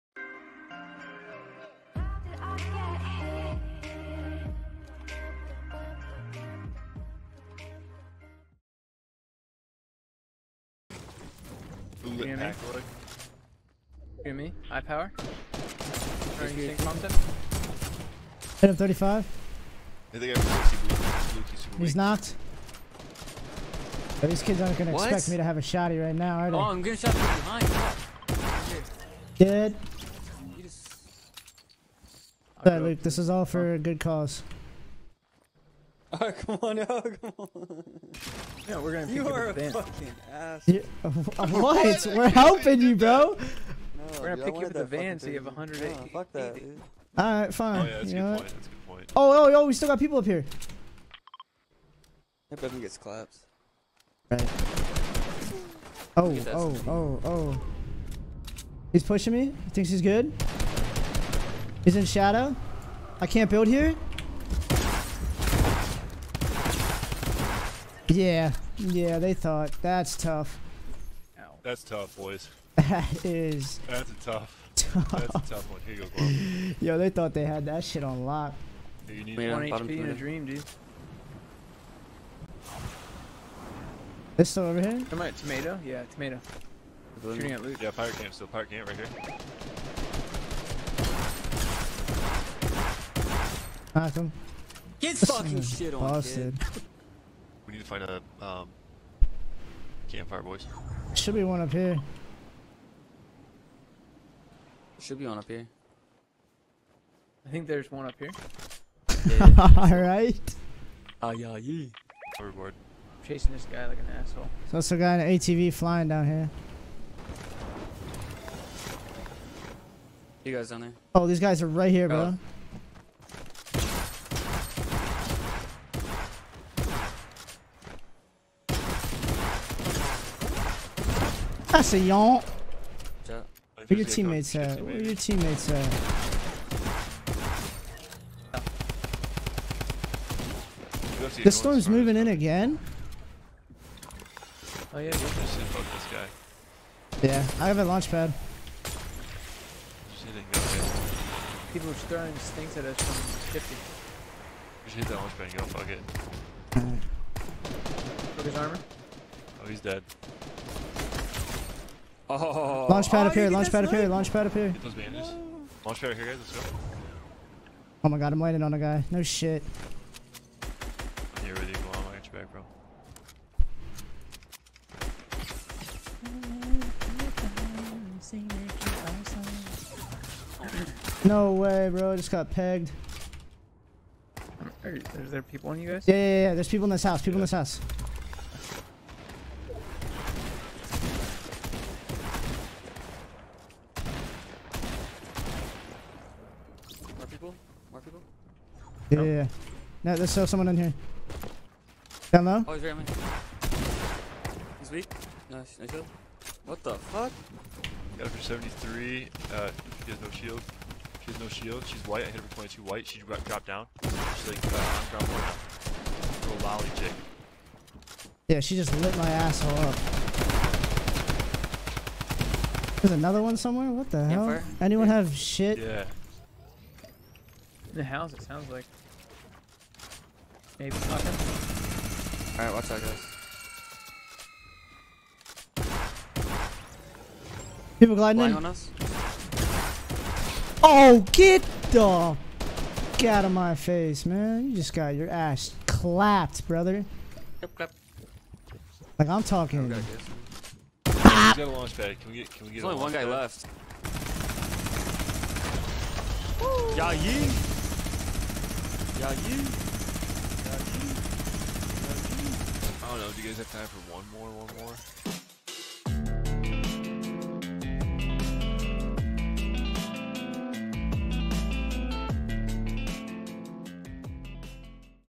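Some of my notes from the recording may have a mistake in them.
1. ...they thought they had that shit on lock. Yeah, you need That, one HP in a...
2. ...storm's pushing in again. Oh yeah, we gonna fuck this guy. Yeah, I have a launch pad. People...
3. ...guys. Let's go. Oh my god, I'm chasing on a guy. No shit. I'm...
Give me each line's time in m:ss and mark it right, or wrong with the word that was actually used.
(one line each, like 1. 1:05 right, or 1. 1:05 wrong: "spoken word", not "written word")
1. 1:16 wrong: "Wait", not "That"
2. 2:21 wrong: "moving", not "pushing"
3. 2:46 wrong: "waiting", not "chasing".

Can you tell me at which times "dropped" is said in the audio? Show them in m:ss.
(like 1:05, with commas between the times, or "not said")
3:33.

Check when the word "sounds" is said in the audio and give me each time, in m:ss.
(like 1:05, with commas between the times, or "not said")
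3:48.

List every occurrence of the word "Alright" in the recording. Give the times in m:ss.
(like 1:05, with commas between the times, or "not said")
0:47, 1:49, 3:52.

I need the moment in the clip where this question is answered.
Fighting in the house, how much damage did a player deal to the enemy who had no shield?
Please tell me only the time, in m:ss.
3:28.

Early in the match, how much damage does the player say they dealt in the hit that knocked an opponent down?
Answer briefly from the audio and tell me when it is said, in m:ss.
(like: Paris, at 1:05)
35, at 0:16.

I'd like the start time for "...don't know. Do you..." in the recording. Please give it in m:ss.
4:23.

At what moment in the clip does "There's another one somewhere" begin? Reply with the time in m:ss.
3:43.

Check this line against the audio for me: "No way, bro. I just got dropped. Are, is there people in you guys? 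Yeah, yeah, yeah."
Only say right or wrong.
wrong.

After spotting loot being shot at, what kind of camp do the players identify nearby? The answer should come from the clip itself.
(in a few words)
Pirate camp.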